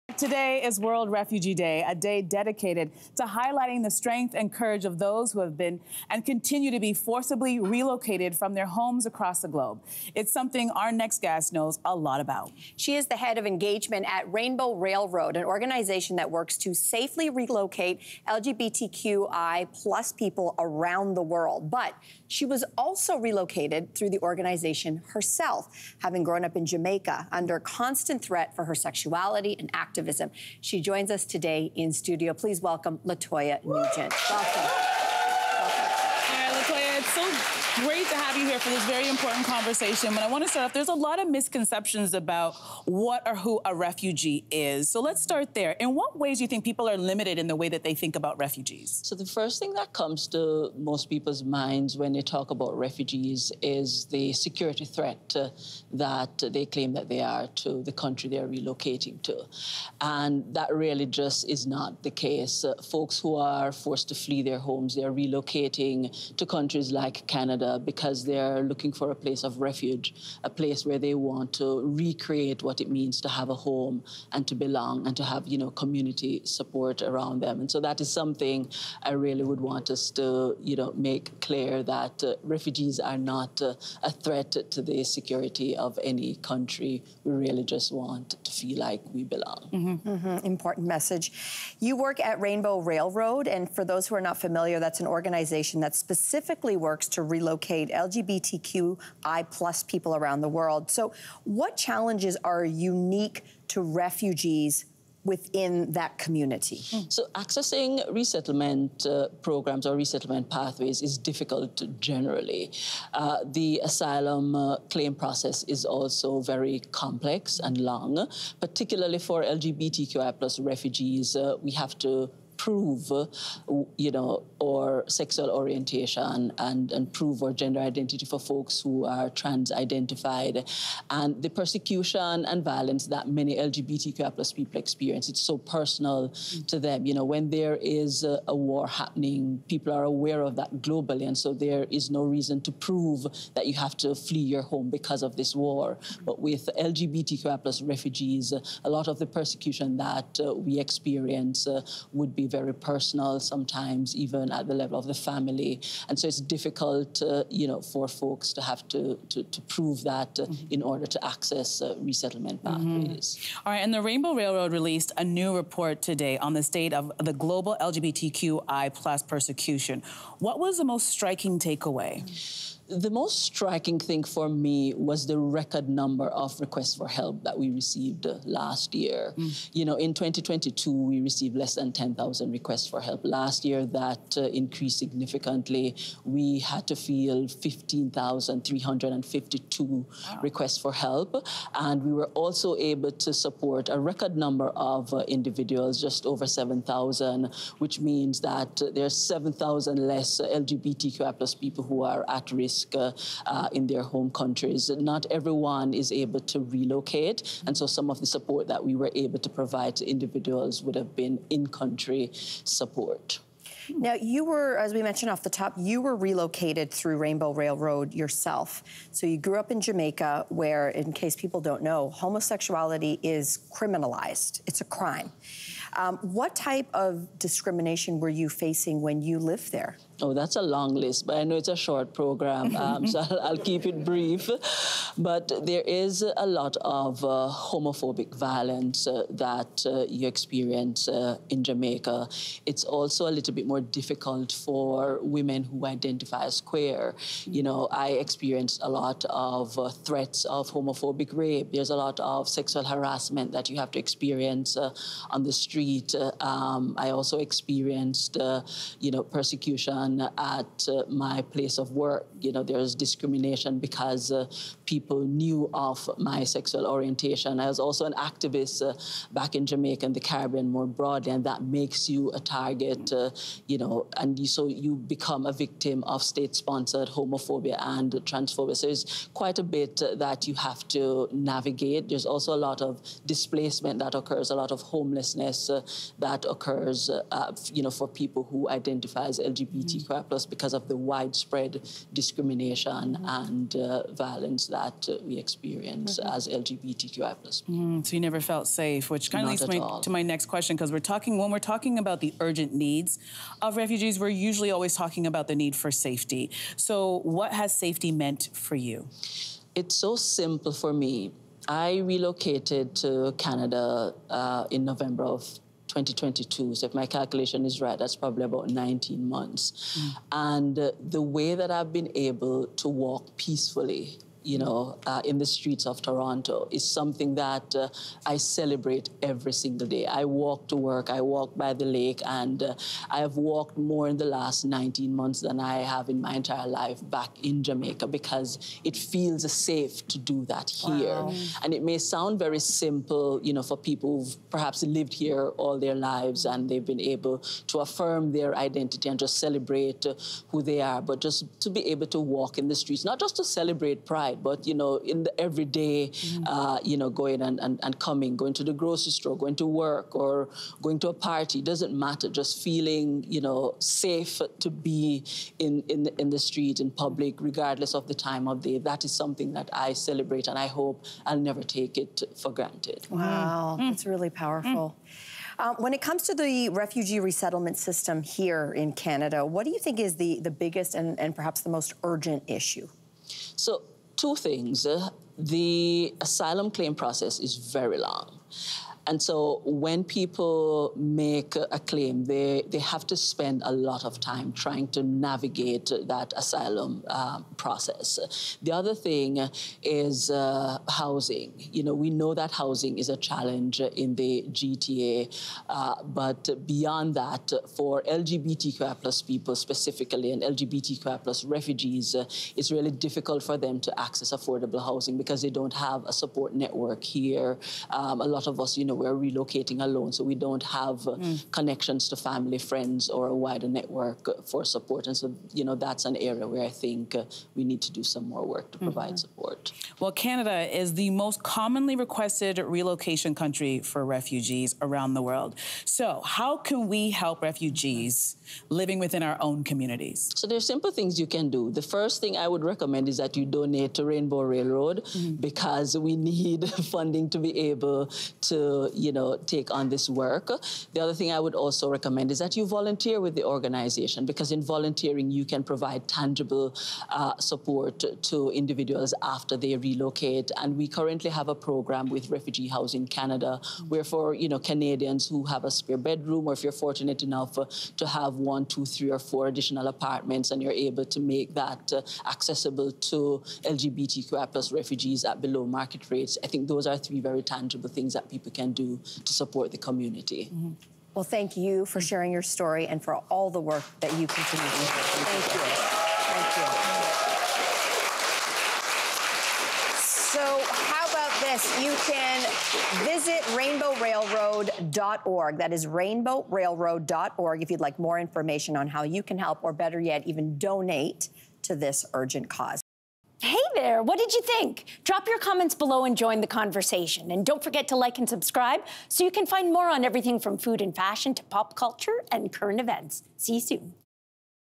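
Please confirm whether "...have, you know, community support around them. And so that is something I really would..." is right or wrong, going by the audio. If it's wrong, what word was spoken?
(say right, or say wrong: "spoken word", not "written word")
right.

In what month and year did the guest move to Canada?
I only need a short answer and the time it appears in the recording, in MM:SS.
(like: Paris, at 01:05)
November 2022, at 05:14.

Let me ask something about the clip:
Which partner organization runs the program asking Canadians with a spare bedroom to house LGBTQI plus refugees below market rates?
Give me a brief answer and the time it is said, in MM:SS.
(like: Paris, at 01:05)
Refugee Housing Canada, at 07:42.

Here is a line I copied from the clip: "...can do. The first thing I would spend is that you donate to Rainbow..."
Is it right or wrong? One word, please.
wrong.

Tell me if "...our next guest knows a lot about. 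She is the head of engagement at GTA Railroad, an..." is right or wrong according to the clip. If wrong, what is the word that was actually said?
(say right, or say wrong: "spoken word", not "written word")
wrong: "Rainbow", not "GTA".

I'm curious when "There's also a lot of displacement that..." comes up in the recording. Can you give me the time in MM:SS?
04:42.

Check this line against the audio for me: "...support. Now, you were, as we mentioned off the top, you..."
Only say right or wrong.
right.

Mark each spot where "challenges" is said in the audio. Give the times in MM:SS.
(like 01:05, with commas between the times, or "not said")
01:41, 06:43.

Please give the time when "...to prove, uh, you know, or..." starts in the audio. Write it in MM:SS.
02:02.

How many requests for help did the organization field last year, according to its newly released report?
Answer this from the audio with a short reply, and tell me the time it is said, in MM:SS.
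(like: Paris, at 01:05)
15,352, at 03:07.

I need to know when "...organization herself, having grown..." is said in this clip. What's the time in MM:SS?
00:24.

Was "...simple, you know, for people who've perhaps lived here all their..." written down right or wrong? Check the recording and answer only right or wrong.
right.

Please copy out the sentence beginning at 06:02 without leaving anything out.
Just feeling, you know, safe to be in, in, the, in the street, in public, regardless of the time of day.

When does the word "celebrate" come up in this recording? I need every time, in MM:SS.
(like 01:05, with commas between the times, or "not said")
05:28, 05:49, 05:53, 06:09.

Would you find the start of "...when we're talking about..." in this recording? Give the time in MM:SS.
05:01.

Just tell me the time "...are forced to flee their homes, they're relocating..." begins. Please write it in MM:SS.
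01:03.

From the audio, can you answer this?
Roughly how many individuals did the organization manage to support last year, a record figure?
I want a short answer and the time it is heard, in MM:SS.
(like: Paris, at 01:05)
just over 7,000, at 03:16.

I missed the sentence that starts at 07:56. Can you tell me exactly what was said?
I think those are three very tangible things that people can can do to support the community.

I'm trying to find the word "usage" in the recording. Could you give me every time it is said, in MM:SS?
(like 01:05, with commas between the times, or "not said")
not said.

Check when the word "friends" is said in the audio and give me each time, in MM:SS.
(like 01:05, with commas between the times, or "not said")
07:02.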